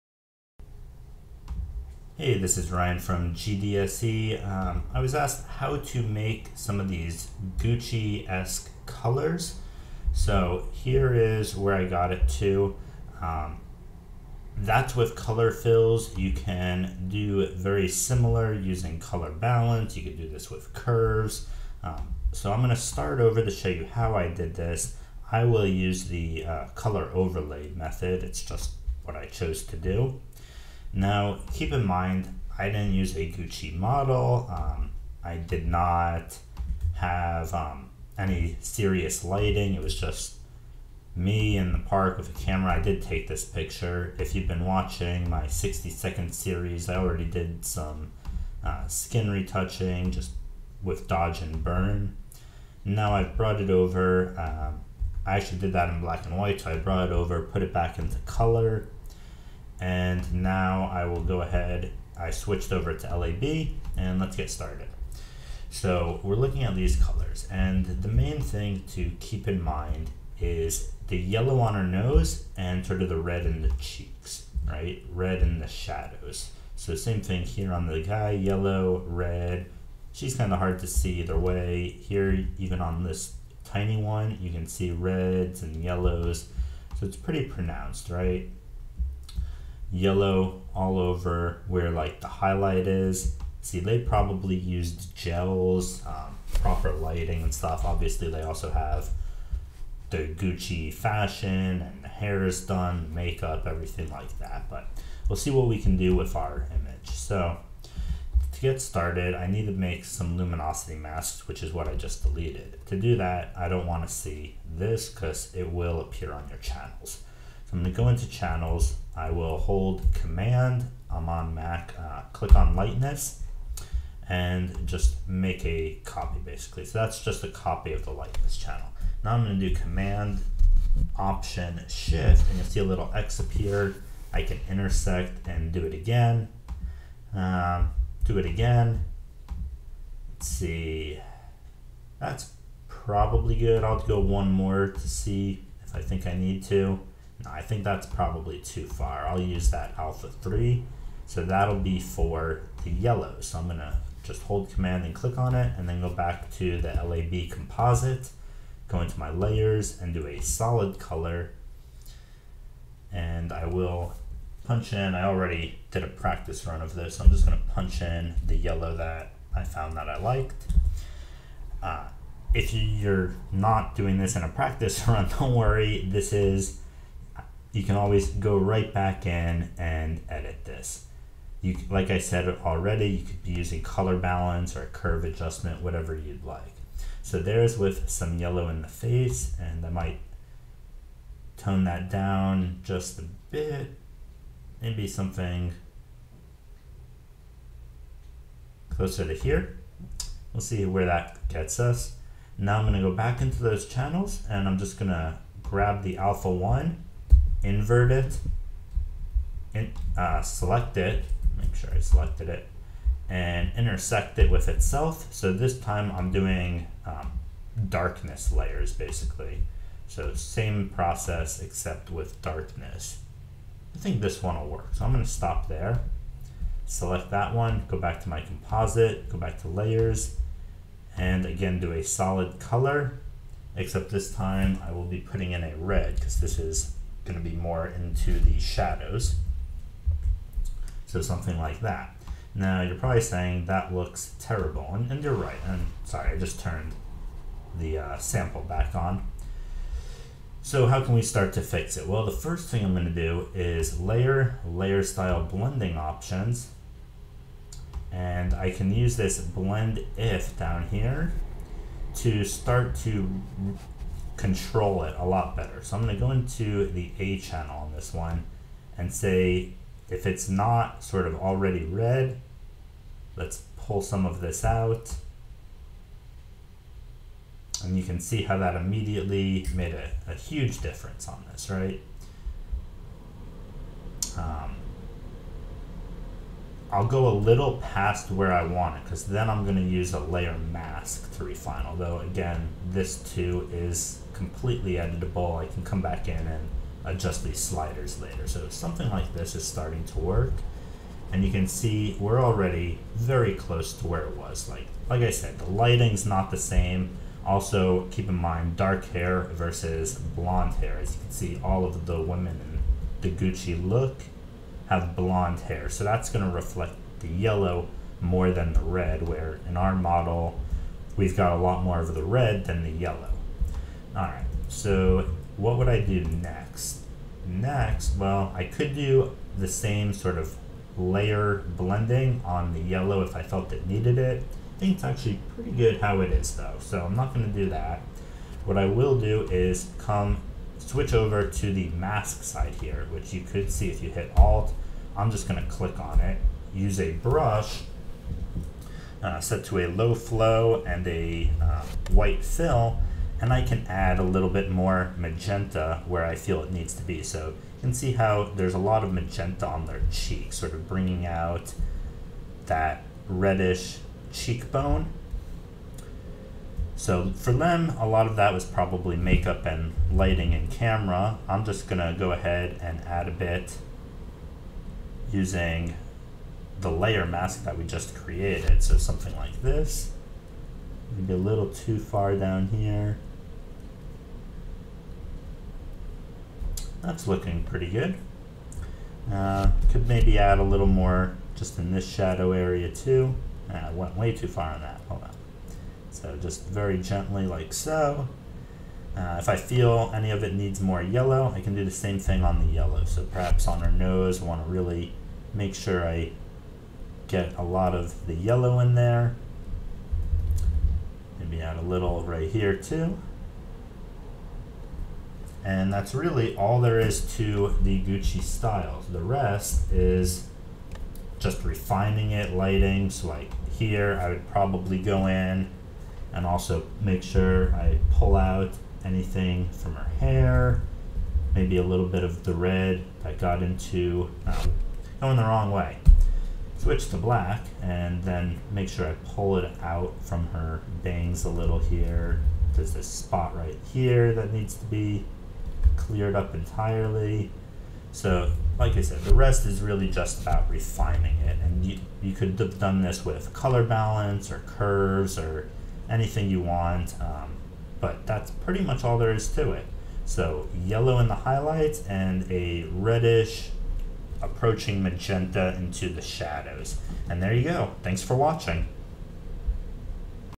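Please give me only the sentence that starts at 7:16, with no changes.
Switch to black and then make sure I pull it out from her bangs a little here.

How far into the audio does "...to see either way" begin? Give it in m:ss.
1:20.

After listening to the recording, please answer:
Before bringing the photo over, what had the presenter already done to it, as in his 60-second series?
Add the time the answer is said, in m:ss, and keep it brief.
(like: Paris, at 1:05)
Skin retouching, at 0:48.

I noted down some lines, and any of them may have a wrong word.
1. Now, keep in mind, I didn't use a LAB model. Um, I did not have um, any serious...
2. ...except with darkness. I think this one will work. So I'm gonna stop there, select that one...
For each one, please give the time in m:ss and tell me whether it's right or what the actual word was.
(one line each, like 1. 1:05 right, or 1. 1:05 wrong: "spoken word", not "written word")
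1. 0:30 wrong: "Gucci", not "LAB"
2. 3:41 right.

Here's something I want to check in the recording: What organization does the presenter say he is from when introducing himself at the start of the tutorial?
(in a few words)
GDSE.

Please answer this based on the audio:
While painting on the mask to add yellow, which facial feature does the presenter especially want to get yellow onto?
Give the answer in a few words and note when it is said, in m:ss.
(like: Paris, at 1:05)
Her nose, at 6:43.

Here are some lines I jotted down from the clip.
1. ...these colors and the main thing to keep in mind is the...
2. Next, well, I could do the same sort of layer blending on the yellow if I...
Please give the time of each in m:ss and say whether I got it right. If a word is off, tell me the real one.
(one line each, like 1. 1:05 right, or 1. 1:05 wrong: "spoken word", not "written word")
1. 1:06 right
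2. 5:27 right.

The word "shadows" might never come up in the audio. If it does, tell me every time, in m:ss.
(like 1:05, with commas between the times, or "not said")
1:15, 3:58, 6:32, 7:46.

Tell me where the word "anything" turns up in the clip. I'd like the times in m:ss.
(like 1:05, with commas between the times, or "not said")
7:09, 7:36.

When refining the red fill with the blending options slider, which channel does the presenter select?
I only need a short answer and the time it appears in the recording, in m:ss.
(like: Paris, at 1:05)
A channel, at 4:27.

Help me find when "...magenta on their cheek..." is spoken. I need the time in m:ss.
5:59.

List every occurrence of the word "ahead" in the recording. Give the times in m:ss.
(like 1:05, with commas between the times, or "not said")
1:01, 6:12.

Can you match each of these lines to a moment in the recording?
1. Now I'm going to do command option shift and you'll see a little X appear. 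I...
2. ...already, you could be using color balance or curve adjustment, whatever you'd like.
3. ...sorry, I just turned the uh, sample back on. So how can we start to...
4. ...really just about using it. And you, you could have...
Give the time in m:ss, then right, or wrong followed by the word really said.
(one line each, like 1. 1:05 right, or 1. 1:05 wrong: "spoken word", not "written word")
1. 2:09 right
2. 3:02 right
3. 4:06 right
4. 7:29 wrong: "refining", not "using".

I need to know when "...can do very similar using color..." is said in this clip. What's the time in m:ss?
0:16.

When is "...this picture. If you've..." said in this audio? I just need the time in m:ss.
0:43.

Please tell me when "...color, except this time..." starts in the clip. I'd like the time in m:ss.
3:52.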